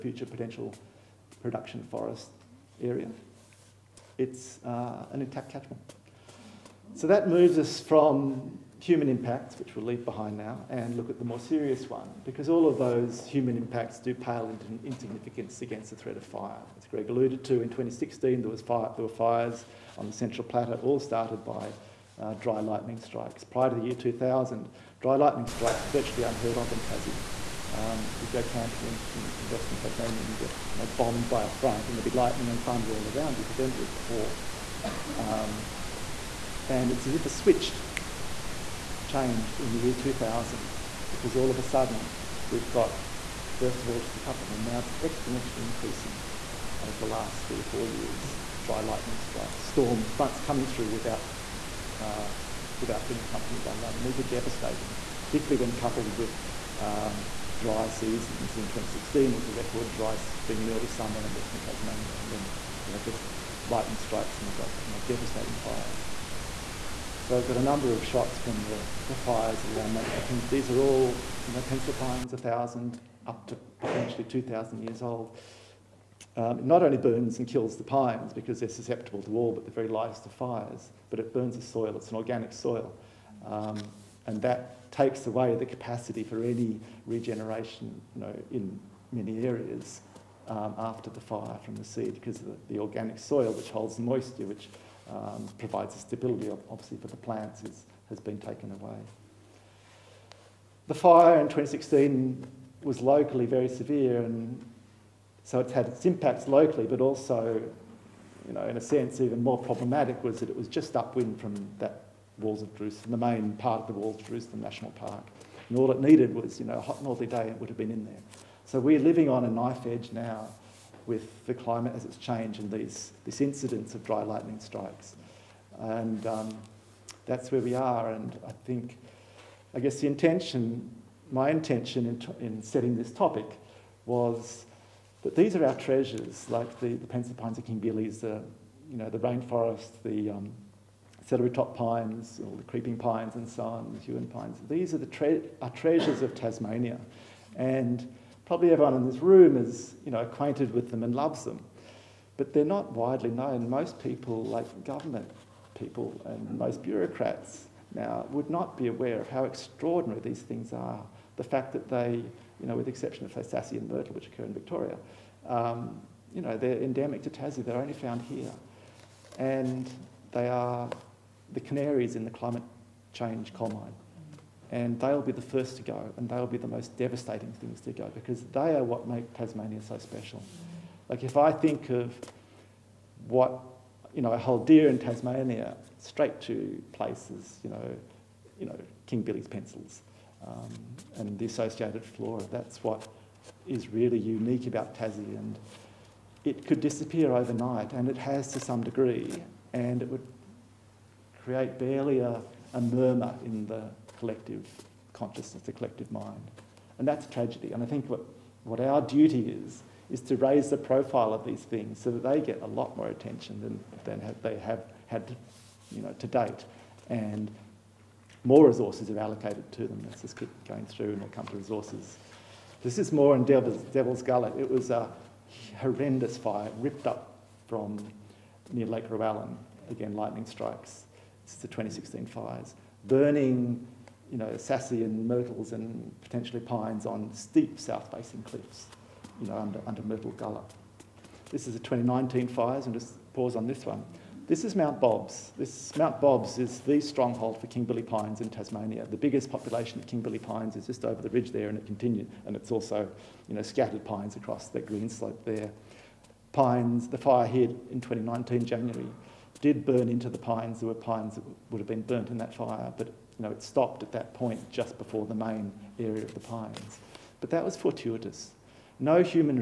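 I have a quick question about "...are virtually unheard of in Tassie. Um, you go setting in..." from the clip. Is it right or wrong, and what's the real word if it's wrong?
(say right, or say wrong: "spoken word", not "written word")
wrong: "camping", not "setting".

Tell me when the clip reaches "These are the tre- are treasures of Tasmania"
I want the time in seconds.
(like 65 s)
144 s.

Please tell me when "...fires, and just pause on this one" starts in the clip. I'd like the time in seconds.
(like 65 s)
242 s.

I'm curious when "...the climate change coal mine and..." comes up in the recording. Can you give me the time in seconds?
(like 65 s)
172 s.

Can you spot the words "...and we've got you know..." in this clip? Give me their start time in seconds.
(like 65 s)
64 s.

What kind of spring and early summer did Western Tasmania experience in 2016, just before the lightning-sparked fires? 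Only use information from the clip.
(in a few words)
Record dry.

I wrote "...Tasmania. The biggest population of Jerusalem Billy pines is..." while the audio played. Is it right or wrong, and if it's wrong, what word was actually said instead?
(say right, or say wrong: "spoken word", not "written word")
wrong: "King", not "Jerusalem".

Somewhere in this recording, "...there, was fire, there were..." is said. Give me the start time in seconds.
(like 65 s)
18 s.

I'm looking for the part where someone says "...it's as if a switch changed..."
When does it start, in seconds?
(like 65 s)
36 s.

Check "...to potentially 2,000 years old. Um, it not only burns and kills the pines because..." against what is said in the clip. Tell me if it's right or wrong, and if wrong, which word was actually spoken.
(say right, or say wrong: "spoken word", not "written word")
right.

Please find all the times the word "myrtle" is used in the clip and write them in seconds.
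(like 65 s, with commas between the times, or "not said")
163 s, 235 s, 240 s.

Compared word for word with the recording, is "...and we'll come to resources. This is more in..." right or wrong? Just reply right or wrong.
right.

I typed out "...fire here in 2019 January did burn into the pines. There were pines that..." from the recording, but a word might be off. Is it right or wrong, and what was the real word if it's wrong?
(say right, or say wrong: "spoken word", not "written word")
right.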